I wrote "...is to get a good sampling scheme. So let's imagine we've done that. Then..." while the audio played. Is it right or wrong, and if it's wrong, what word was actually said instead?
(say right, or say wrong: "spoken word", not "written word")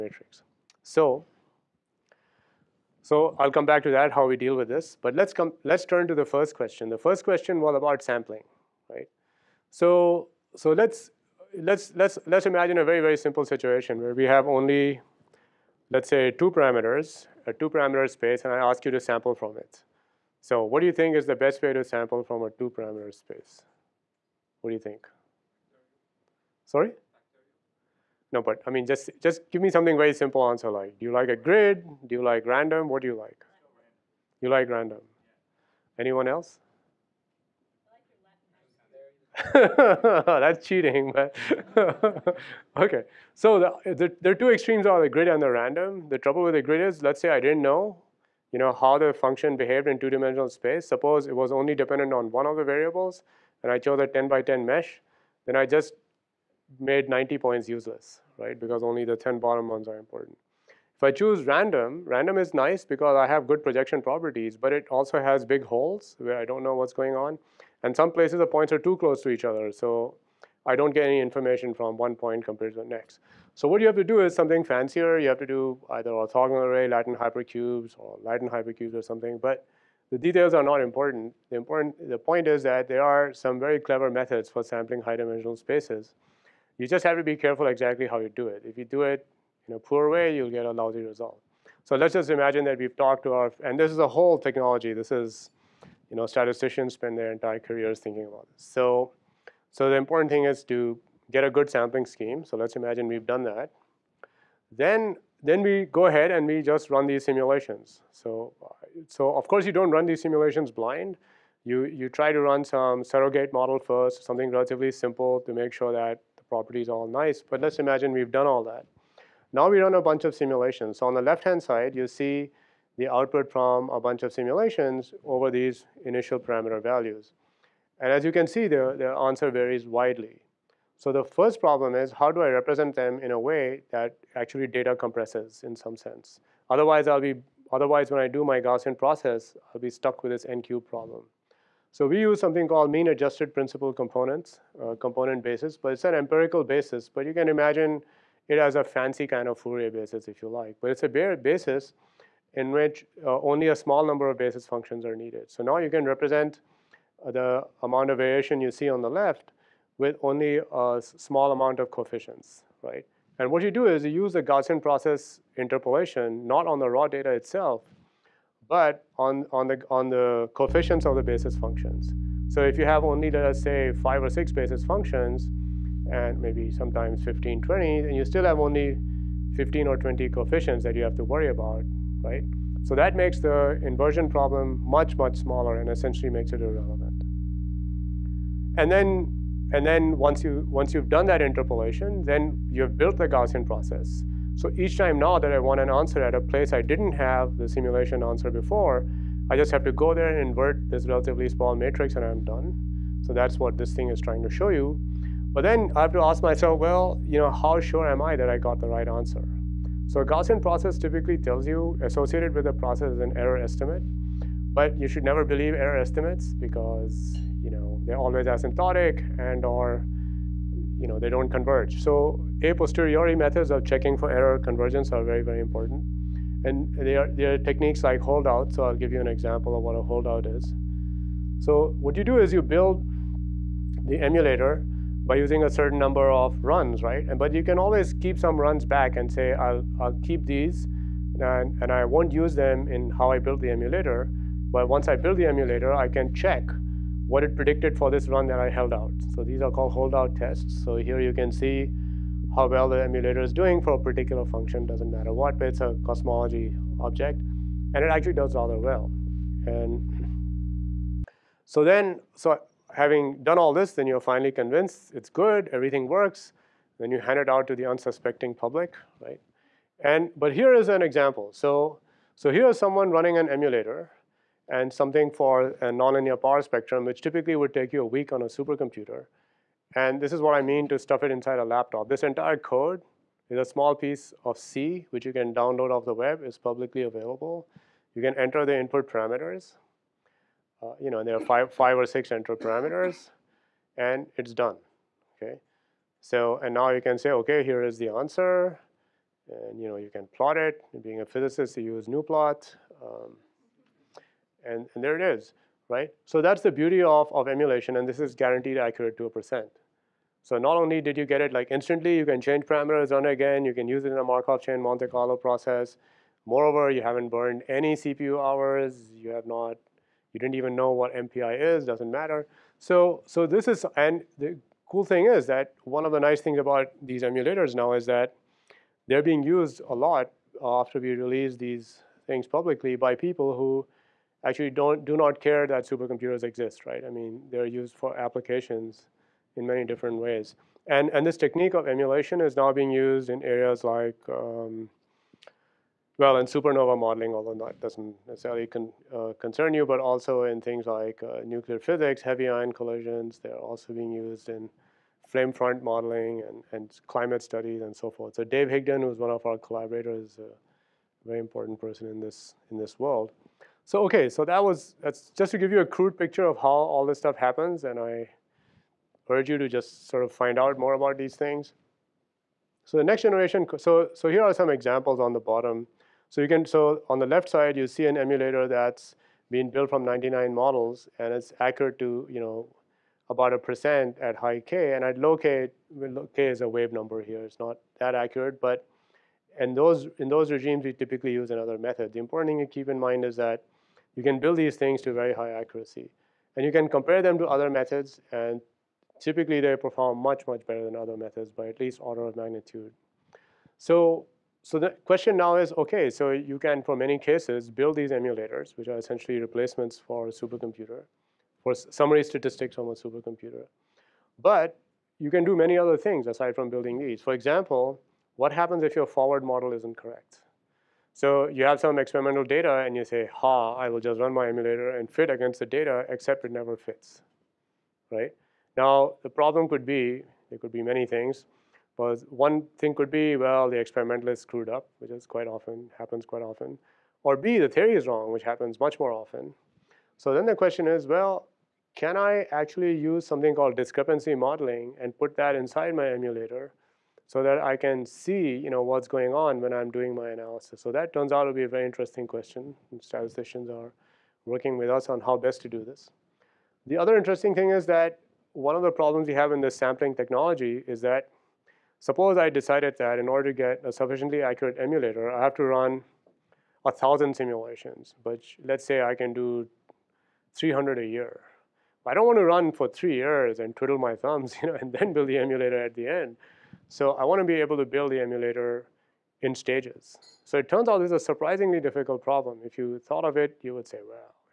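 right.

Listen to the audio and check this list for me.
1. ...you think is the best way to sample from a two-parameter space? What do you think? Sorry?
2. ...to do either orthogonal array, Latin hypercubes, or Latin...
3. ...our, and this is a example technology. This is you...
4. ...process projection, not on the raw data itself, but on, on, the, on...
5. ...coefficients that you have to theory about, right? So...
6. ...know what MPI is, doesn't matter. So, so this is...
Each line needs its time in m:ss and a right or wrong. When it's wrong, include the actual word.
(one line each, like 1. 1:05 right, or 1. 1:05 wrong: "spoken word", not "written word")
1. 0:20 right
2. 1:15 right
3. 1:33 wrong: "whole", not "example"
4. 2:44 wrong: "interpolation", not "projection"
5. 3:00 wrong: "worry", not "theory"
6. 5:20 right.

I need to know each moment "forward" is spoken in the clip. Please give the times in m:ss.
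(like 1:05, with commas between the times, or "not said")
6:59.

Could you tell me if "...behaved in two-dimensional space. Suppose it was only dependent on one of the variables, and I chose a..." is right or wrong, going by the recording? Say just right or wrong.
right.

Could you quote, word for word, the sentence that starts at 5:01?
Being a physicist, you use new um, and, and there it is, right?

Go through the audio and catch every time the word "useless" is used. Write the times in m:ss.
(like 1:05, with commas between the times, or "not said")
0:57.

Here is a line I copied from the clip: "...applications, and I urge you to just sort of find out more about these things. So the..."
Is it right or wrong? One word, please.
wrong.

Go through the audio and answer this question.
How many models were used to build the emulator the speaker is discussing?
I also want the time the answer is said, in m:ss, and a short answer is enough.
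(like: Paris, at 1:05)
99, at 6:20.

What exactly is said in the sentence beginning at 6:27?
It's not that accurate, but and those in those regimes, we typically use another method.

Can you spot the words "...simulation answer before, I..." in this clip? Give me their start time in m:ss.
3:17.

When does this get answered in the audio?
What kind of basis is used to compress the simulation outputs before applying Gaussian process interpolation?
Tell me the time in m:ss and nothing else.
2:22.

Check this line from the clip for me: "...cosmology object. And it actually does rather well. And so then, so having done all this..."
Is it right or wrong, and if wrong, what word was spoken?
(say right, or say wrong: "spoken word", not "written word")
right.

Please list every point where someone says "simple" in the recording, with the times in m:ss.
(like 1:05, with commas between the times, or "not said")
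0:13, 0:30, 1:54.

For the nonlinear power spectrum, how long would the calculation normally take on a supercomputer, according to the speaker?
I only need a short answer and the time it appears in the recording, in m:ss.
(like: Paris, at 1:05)
a week, at 4:38.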